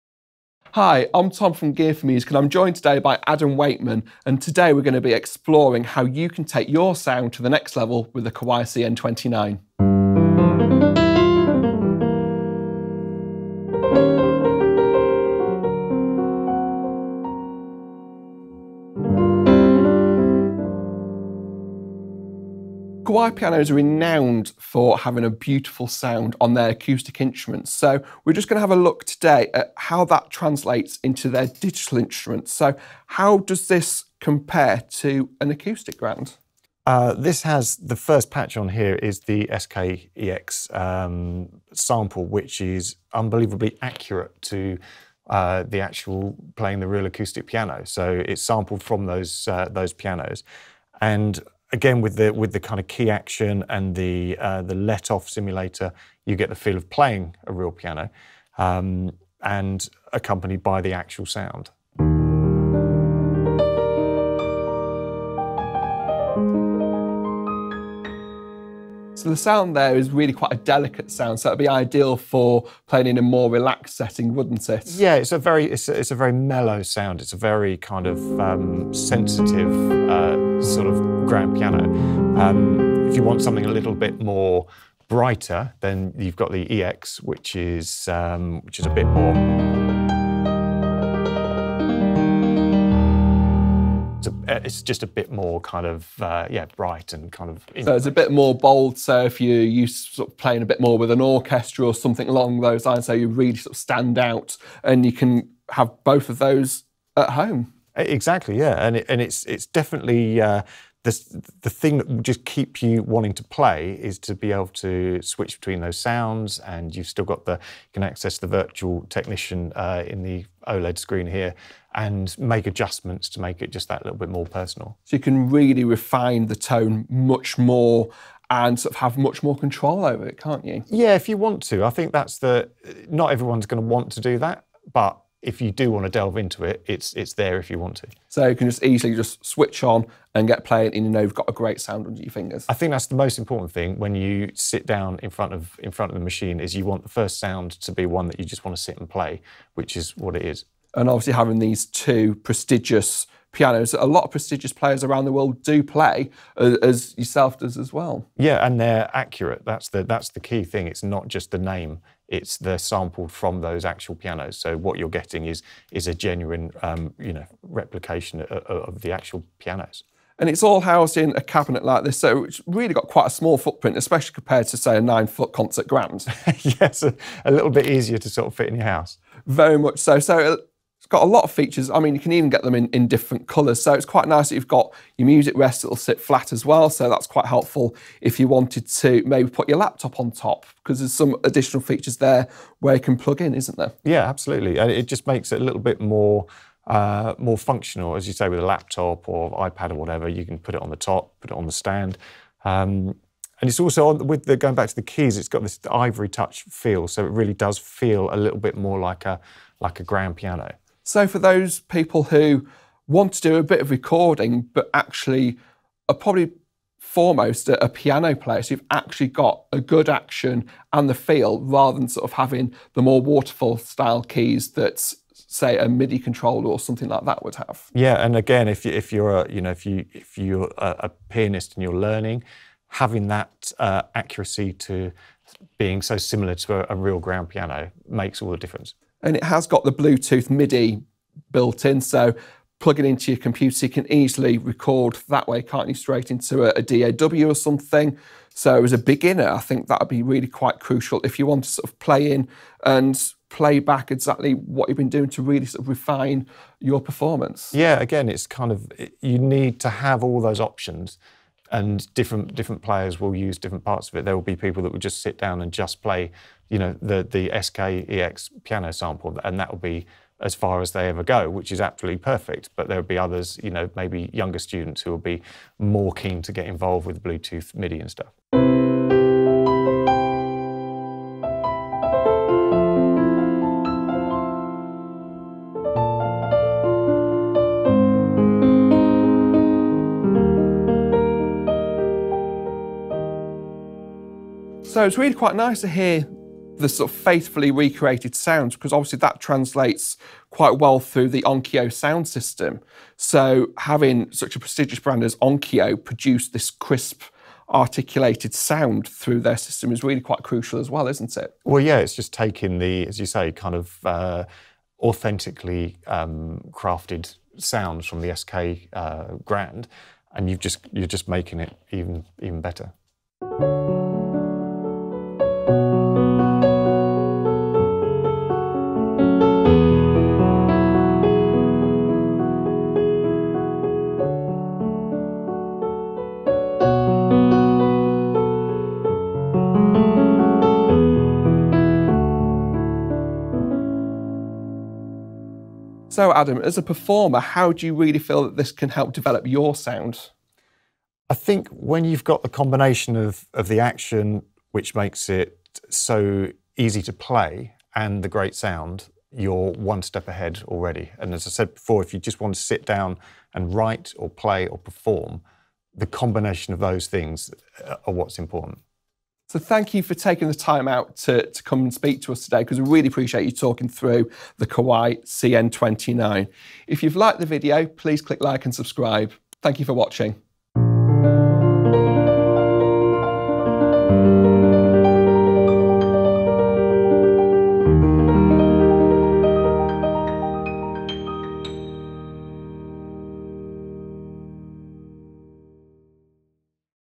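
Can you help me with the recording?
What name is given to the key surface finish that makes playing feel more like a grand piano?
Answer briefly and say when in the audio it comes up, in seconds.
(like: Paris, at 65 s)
Ivory touch, at 205 s.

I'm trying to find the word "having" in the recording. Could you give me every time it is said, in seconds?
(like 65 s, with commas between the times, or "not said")
24 s, 151 s, 222 s, 232 s, 303 s.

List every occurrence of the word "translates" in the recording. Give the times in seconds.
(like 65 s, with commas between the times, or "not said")
30 s, 299 s.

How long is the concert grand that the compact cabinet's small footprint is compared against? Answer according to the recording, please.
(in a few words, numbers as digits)
9 foot.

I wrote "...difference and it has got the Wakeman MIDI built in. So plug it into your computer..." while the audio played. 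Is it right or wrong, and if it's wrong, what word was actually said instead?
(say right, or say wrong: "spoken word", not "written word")
wrong: "Bluetooth", not "Wakeman".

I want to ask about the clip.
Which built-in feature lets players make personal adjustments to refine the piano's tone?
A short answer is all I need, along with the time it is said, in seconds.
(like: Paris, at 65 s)
Virtual technician, at 118 s.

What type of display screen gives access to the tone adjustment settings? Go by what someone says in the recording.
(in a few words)
OLED.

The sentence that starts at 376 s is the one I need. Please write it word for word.
If you've liked the video, please click like and subscribe.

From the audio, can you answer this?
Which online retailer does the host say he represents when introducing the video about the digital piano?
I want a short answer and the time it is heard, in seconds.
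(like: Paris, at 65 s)
Gear4music, at 1 s.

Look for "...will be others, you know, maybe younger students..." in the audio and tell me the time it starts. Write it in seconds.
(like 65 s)
272 s.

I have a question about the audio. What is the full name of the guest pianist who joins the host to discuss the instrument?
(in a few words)
Adam Wakeman.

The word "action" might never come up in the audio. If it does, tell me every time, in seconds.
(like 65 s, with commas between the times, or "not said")
53 s, 220 s, 353 s.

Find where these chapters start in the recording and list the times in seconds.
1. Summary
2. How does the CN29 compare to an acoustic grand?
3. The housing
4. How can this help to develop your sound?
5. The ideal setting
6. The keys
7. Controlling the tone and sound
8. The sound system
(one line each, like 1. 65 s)
1. 370 s
2. 35 s
3. 172 s
4. 346 s
5. 73 s
6. 204 s
7. 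113 s
8. 296 s.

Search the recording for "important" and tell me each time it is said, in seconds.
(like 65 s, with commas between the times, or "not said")
143 s, 368 s.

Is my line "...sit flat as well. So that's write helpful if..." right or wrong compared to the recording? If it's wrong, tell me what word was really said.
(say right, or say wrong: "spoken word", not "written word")
wrong: "quite", not "write".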